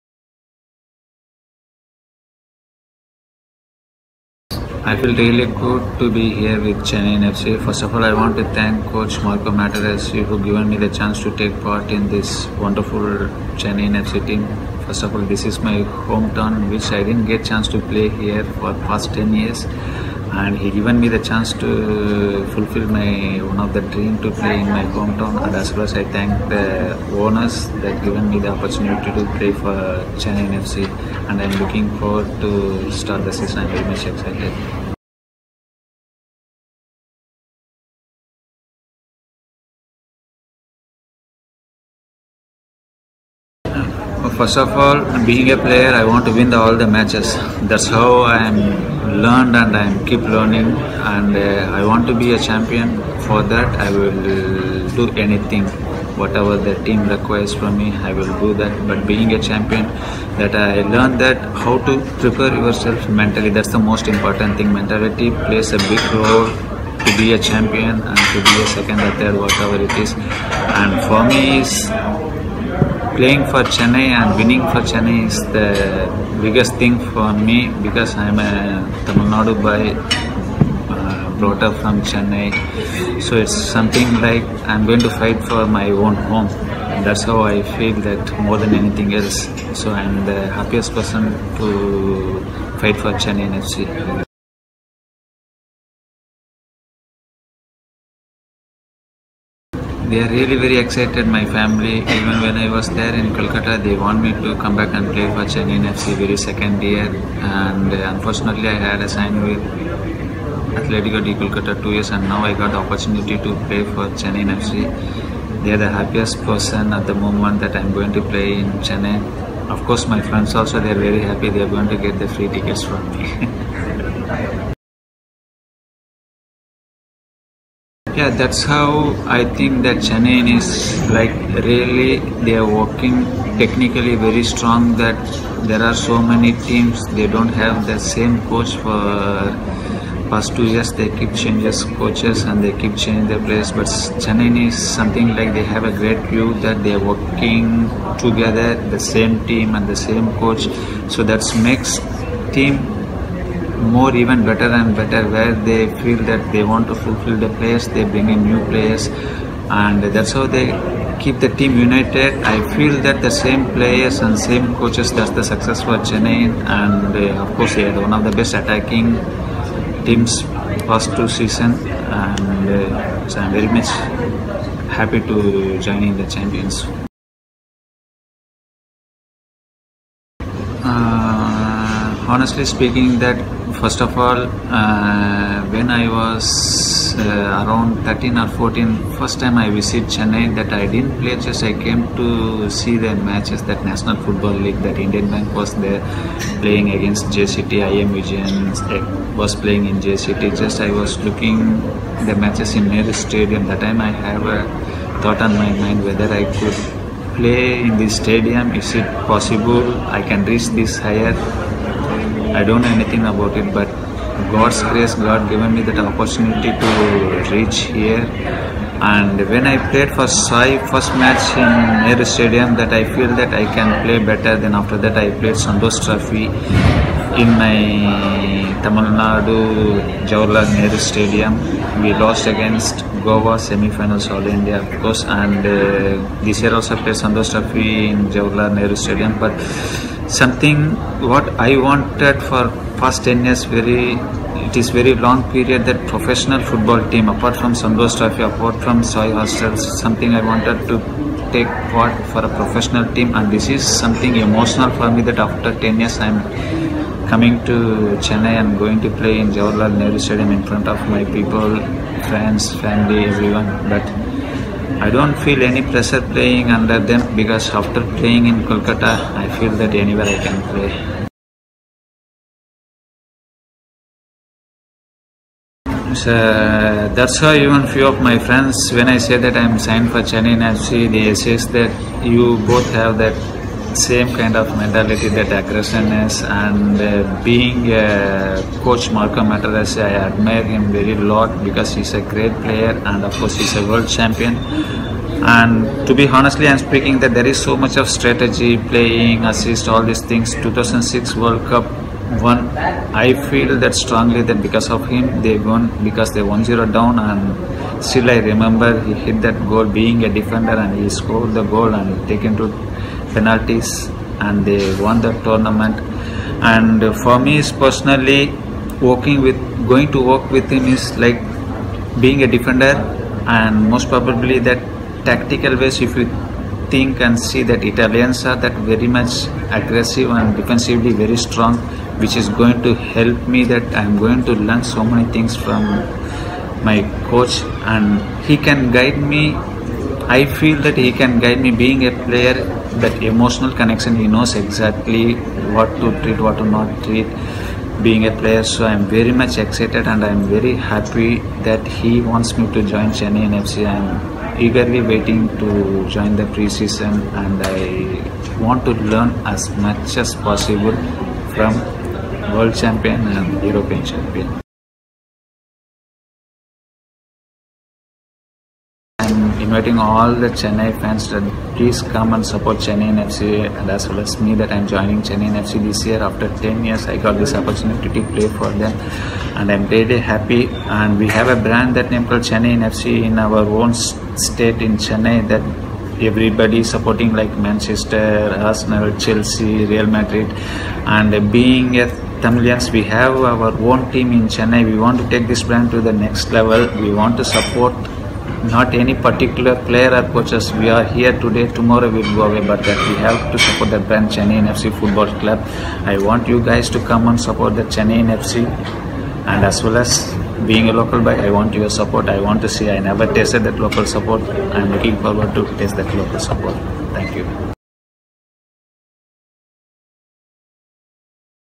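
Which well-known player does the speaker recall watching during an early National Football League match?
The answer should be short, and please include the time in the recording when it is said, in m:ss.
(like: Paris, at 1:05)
I. M. Vijayan, at 3:18.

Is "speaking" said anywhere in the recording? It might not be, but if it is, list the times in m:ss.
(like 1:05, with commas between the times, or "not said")
3:02, 4:56.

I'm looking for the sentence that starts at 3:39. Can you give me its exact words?
And when I played for SAI first match in Nehru Stadium, that I feel that I can play better.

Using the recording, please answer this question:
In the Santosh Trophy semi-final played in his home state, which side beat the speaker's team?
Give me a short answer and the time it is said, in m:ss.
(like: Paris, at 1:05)
Goa, at 3:53.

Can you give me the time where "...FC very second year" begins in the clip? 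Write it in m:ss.
1:45.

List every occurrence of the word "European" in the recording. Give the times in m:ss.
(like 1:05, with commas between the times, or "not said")
6:03.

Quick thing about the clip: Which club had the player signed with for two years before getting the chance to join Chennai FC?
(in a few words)
Atletico de Kolkata.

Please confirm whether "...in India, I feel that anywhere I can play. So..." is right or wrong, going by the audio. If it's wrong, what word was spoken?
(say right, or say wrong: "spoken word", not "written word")
wrong: "Kolkata", not "India".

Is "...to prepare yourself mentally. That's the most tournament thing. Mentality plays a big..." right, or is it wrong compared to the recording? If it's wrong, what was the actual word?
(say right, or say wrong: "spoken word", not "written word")
wrong: "important", not "tournament".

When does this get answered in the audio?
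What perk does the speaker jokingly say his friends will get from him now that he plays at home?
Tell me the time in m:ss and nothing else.
2:02.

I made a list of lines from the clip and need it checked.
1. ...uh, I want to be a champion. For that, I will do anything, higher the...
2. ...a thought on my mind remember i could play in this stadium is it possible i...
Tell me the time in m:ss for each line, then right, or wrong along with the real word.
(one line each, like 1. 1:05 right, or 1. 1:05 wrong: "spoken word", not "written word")
1. 0:51 wrong: "whatever", not "higher"
2. 3:24 wrong: "whether", not "remember".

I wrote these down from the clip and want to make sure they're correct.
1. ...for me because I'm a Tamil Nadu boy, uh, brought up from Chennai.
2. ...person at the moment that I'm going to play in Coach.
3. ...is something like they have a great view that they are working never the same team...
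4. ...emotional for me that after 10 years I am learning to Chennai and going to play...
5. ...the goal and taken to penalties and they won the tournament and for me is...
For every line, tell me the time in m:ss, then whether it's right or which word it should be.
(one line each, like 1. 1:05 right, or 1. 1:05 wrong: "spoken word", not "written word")
1. 1:17 right
2. 1:56 wrong: "Chennai", not "Coach"
3. 2:24 wrong: "together", not "never"
4. 4:14 wrong: "coming", not "learning"
5. 5:11 right.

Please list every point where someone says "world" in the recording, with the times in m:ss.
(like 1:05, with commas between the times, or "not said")
4:53, 5:01, 6:02.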